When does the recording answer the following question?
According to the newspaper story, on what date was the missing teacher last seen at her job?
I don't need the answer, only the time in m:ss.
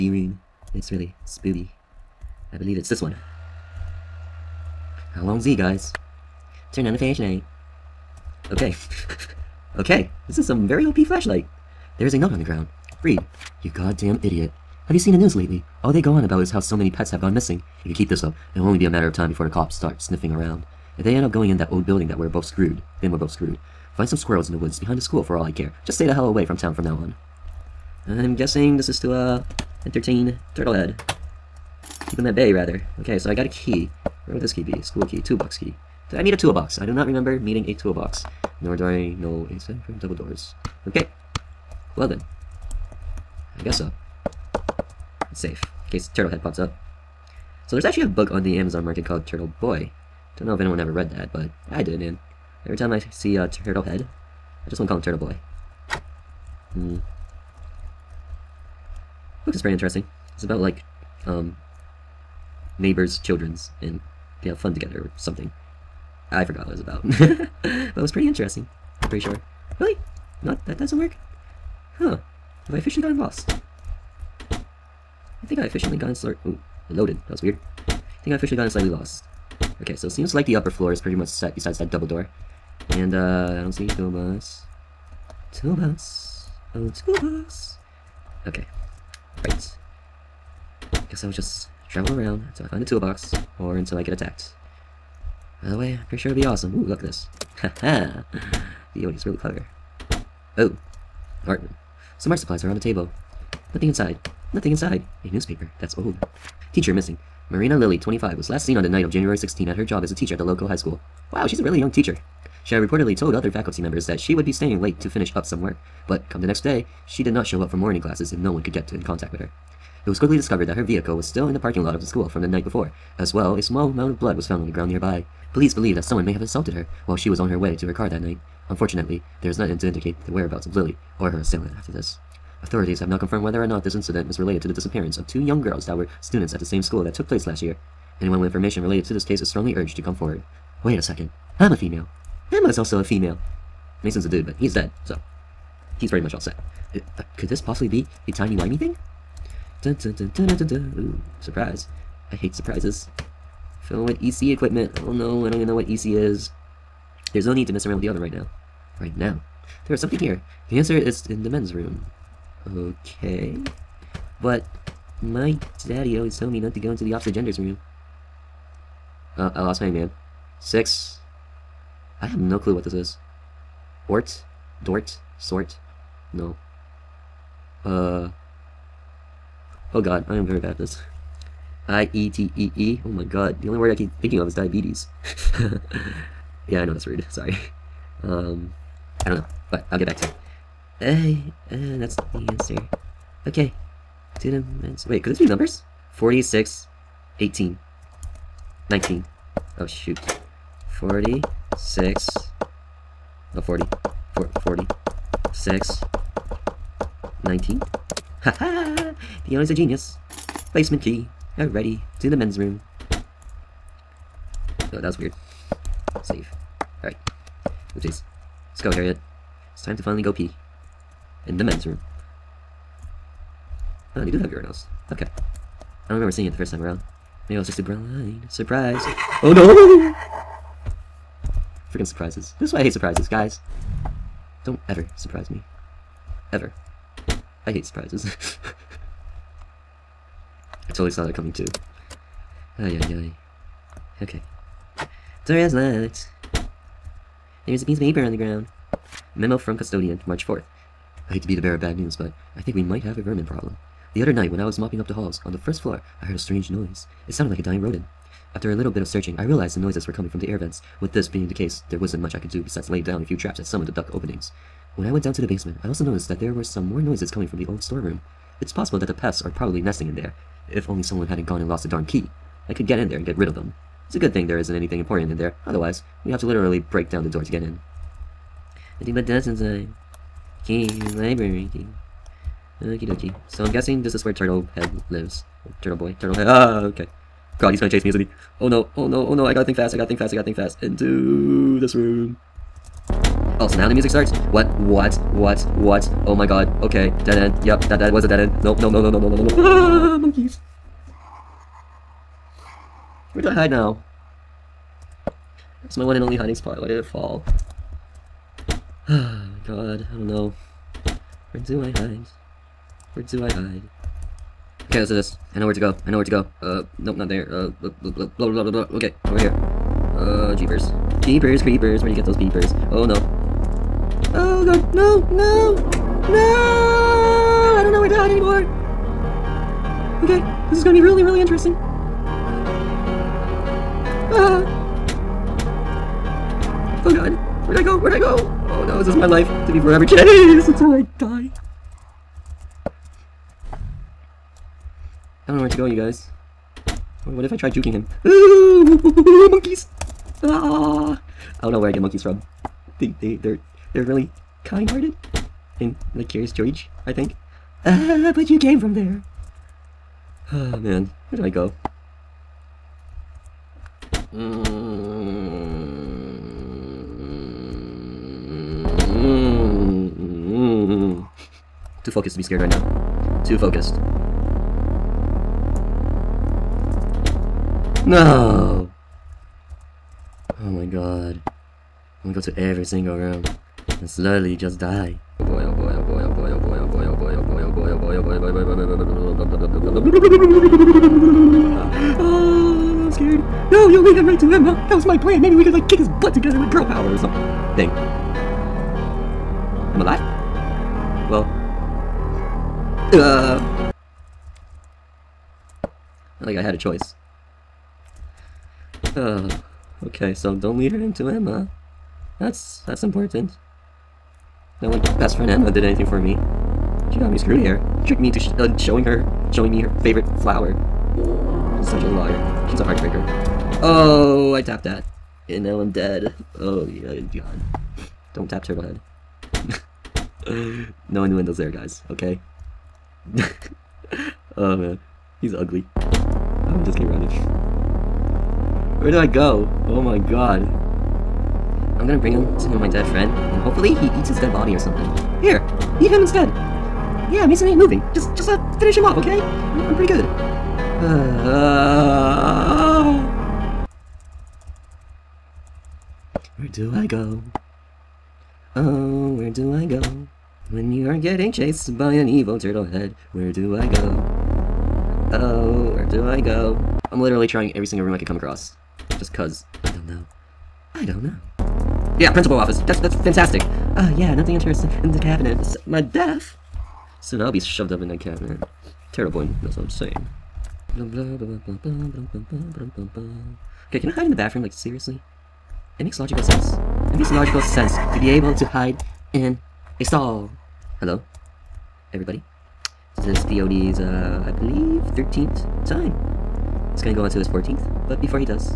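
1:49.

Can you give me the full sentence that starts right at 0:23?
Find some squirrels in the woods behind the school for all I care.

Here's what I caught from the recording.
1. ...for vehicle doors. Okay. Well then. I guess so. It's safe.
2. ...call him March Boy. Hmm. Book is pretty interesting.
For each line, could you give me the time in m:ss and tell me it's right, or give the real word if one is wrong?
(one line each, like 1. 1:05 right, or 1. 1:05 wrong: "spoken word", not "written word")
1. 0:39 wrong: "double", not "vehicle"
2. 0:54 wrong: "Turtle", not "March".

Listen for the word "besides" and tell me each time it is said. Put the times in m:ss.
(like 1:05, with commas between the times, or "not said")
1:21, 4:22.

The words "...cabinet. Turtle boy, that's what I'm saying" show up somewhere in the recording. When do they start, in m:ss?
7:58.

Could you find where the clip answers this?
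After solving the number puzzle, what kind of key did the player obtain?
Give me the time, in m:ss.
3:30.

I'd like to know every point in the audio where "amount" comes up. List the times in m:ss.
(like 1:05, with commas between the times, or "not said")
2:03.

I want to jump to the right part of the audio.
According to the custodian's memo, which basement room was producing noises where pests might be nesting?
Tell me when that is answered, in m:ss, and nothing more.
4:27.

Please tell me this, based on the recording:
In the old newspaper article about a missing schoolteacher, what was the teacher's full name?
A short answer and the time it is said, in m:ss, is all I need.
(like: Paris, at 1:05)
Marina Lilly, at 1:47.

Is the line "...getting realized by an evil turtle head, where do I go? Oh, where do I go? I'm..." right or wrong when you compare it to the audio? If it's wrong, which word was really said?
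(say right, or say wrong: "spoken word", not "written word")
wrong: "chased", not "realized".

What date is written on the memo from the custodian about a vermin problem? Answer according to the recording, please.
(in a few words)
March 4th.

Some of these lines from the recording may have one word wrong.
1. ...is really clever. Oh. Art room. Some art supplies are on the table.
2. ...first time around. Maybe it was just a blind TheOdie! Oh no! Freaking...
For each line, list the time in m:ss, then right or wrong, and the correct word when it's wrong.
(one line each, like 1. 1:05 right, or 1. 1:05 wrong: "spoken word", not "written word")
1. 1:39 right
2. 3:46 wrong: "Surprise", not "TheOdie".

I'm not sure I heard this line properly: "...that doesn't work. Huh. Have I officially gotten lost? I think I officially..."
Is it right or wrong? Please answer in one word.
right.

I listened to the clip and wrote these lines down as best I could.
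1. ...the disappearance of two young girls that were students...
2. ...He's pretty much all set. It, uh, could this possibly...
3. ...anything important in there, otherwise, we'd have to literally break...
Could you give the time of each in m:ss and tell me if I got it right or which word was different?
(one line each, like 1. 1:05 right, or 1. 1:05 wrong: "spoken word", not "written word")
1. 2:14 right
2. 2:26 right
3. 4:34 right.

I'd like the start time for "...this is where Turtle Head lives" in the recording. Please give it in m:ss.
4:44.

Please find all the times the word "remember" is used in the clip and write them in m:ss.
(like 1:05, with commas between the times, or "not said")
0:37, 3:46.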